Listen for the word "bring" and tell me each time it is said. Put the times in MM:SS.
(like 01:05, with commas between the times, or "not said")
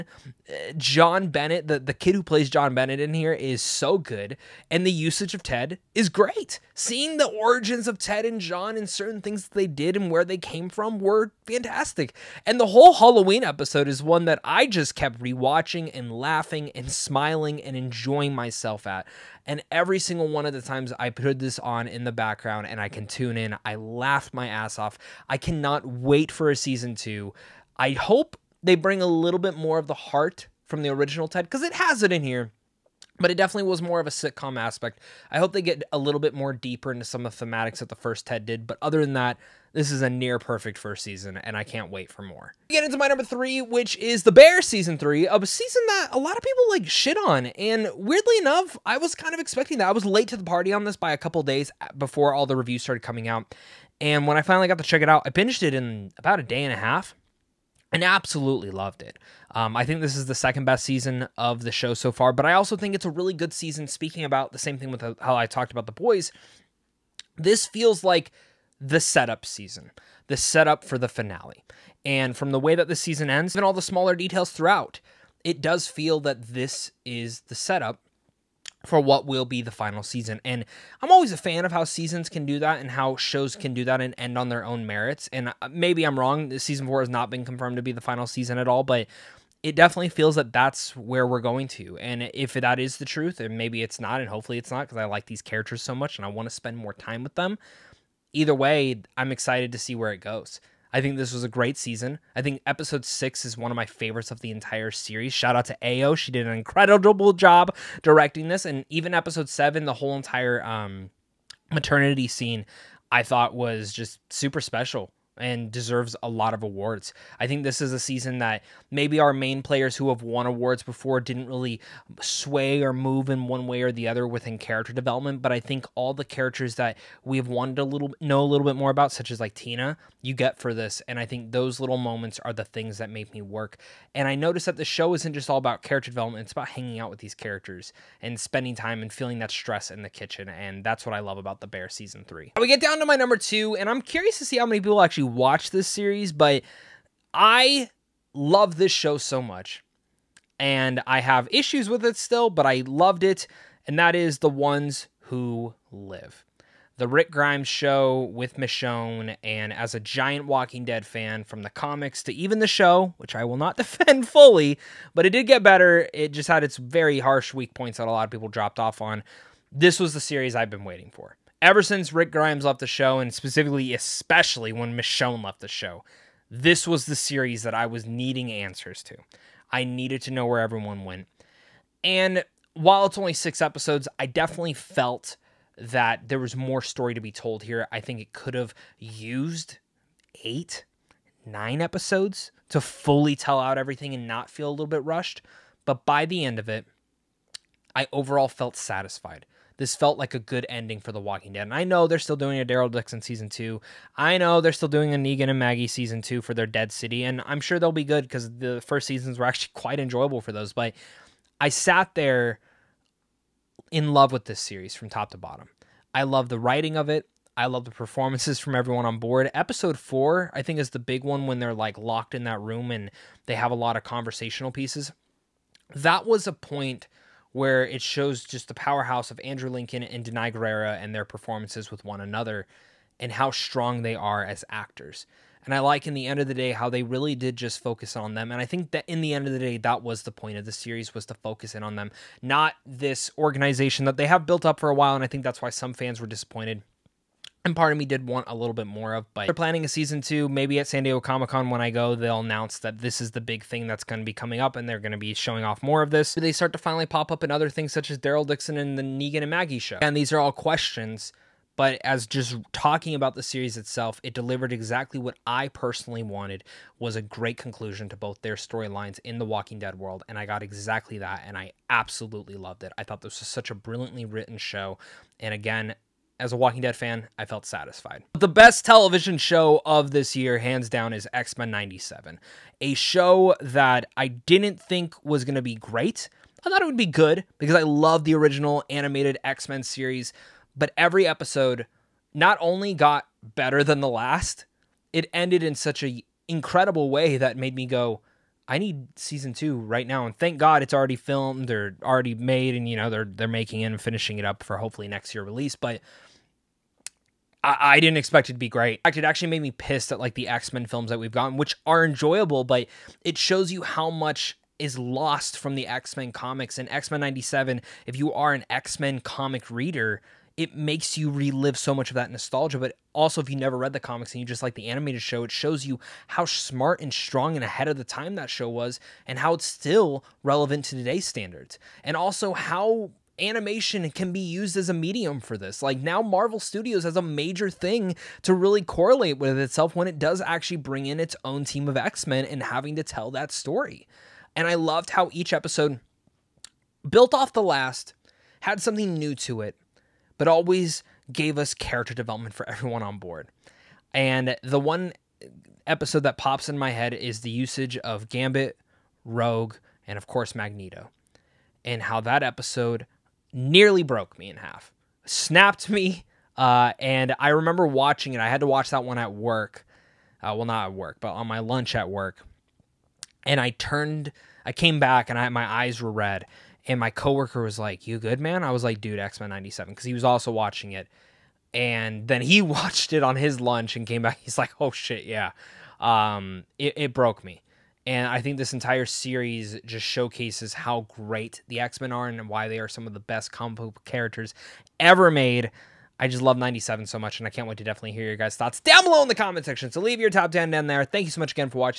00:28, 05:40.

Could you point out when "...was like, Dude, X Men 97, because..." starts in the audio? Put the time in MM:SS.
06:18.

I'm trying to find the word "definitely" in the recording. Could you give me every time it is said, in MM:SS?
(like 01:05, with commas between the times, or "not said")
00:33, 01:29, 03:04, 06:37.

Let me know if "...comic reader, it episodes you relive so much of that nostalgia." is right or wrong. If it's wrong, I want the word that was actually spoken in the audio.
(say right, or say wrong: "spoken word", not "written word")
wrong: "makes", not "episodes".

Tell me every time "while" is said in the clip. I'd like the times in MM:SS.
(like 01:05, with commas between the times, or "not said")
03:02, 04:04.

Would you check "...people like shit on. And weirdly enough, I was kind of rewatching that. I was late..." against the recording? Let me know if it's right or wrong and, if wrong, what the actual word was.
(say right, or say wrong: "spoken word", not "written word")
wrong: "expecting", not "rewatching".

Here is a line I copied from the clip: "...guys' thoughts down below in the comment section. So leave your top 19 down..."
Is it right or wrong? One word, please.
wrong.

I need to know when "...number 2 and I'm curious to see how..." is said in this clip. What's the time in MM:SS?
02:23.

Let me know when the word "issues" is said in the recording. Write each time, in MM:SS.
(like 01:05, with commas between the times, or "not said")
02:31.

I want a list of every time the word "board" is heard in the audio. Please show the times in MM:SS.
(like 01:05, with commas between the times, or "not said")
03:39, 05:53.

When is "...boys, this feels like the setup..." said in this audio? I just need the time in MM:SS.
01:05.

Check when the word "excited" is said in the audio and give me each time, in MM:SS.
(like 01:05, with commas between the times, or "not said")
01:39.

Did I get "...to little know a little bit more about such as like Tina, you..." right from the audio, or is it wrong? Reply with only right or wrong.
right.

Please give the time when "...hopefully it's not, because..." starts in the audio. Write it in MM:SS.
01:34.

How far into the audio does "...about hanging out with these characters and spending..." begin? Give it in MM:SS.
02:16.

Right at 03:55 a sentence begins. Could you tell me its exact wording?
And I like in the end of the day how they really did just focus on them.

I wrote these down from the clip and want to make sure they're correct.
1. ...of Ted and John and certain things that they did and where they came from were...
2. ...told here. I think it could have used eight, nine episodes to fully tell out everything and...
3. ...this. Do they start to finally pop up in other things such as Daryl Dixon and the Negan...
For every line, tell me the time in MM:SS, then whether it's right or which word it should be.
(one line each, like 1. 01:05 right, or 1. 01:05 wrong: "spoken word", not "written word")
1. 00:07 right
2. 03:07 right
3. 04:16 right.